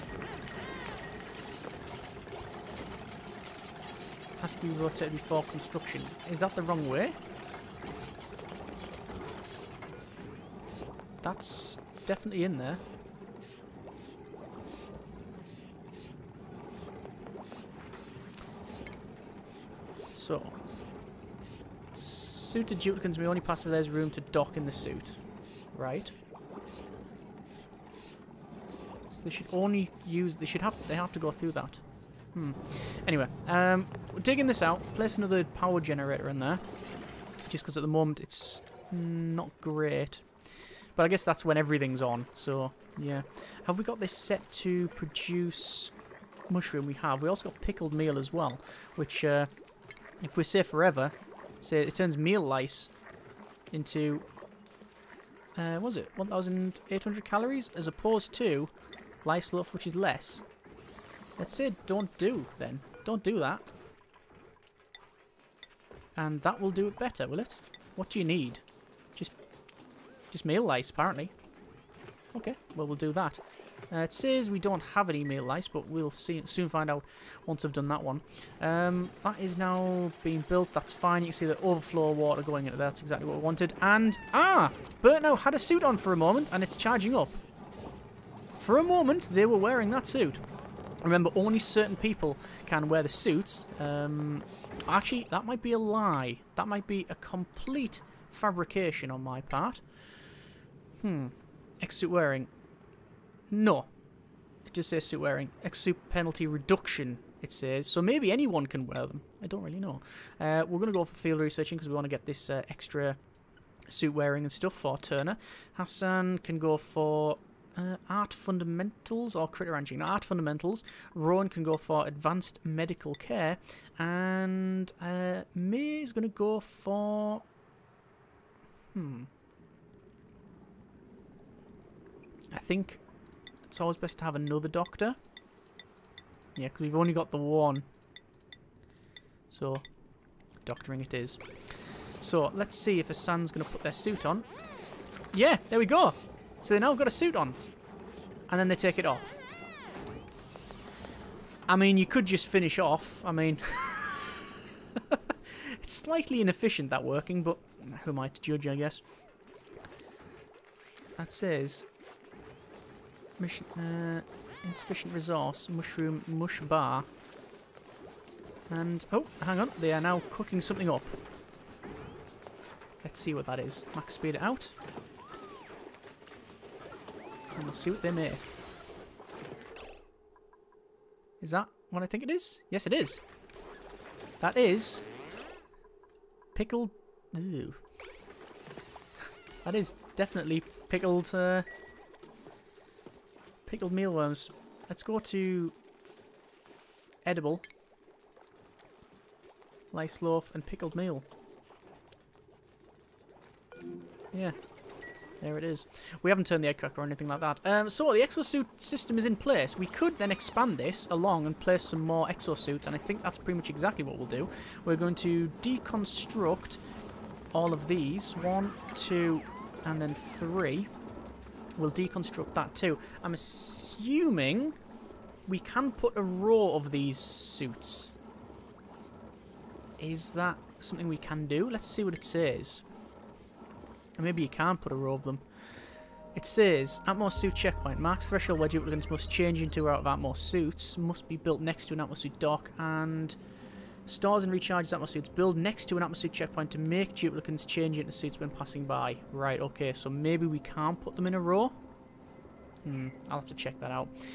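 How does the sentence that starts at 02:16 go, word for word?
Yeah, because we've only got the one.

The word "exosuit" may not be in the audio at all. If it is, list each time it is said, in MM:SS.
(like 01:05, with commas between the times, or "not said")
03:28, 03:32.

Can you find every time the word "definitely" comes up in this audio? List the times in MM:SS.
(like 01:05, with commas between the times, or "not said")
00:12, 03:10.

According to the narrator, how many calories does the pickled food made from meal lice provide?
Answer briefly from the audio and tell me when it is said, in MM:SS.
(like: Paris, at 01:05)
1,800, at 00:56.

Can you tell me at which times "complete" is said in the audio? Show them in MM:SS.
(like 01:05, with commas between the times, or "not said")
01:37.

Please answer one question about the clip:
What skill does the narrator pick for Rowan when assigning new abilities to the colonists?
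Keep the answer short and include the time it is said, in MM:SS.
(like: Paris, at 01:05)
Advanced medical care, at 02:02.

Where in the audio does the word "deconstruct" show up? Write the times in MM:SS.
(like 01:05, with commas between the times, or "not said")
03:35, 03:41.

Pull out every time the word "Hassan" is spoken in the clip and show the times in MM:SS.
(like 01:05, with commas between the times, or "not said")
01:55, 02:23.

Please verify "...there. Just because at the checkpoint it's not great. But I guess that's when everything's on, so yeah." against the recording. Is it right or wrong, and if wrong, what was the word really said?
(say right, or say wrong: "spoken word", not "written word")
wrong: "moment", not "checkpoint".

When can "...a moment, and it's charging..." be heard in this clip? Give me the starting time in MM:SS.
01:26.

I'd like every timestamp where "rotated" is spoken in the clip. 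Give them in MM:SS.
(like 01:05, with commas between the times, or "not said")
00:04.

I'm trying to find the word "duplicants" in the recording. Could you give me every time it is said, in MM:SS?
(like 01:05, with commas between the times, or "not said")
00:22, 03:58, 04:07.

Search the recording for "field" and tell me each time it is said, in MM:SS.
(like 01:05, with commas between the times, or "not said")
01:51.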